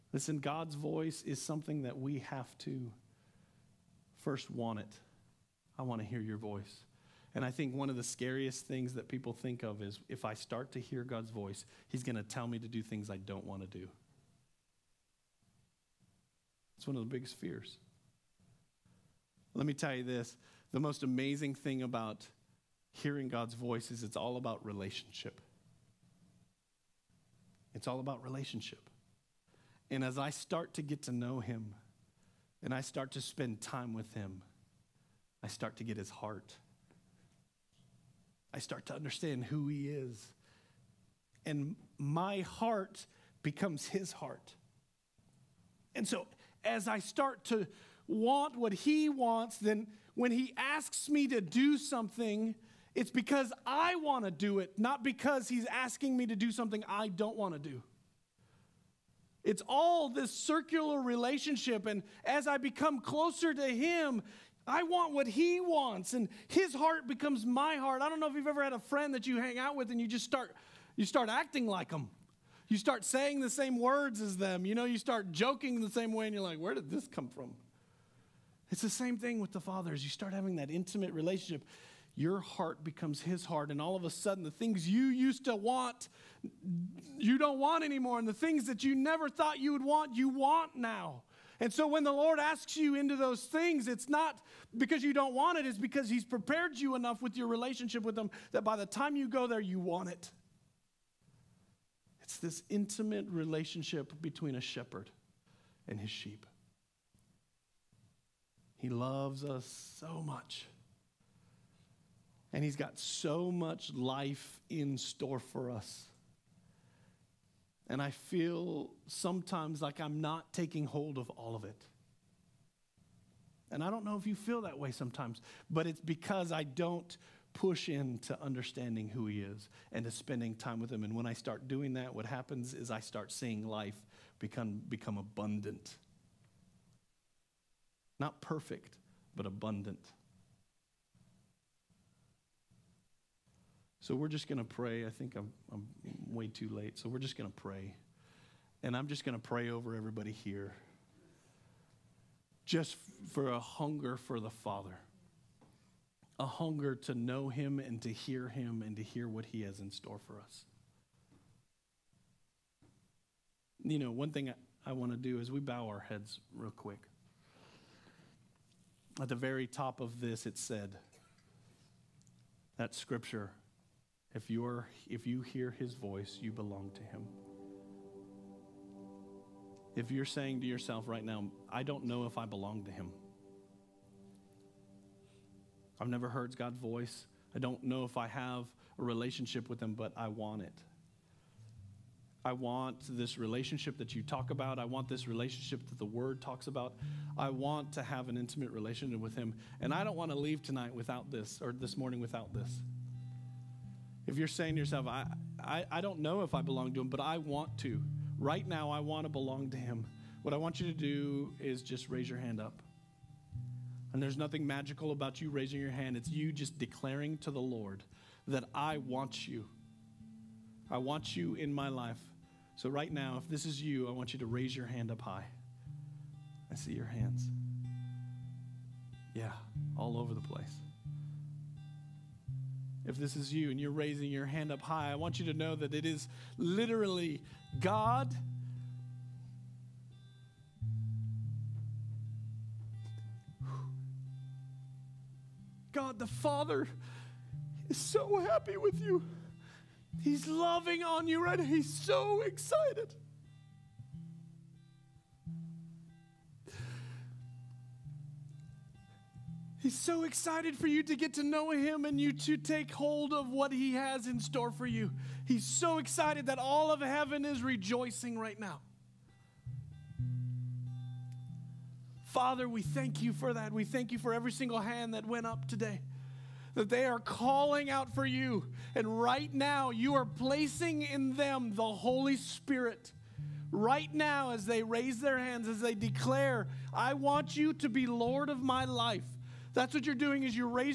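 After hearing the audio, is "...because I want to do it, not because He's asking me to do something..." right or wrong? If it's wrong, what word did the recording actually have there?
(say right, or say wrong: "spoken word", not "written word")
right.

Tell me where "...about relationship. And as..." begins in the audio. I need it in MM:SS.
00:27.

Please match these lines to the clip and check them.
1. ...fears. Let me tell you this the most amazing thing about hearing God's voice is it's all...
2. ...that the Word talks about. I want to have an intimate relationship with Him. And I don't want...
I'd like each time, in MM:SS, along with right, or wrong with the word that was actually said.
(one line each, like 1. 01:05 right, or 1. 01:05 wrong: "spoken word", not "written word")
1. 00:17 right
2. 03:15 right.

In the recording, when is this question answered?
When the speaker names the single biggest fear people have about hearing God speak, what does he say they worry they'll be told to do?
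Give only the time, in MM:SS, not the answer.
00:12.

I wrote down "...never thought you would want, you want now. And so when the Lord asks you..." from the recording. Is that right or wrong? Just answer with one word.
right.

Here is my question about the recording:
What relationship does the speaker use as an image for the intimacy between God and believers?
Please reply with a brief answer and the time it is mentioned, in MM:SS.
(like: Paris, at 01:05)
shepherd and his sheep, at 01:44.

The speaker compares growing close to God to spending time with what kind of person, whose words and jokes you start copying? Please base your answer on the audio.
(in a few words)
a friend.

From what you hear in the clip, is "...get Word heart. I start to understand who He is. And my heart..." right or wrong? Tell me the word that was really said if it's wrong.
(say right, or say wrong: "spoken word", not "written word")
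wrong: "His", not "Word".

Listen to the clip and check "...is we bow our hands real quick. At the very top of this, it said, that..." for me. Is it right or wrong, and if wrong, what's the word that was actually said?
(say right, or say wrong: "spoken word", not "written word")
wrong: "heads", not "hands".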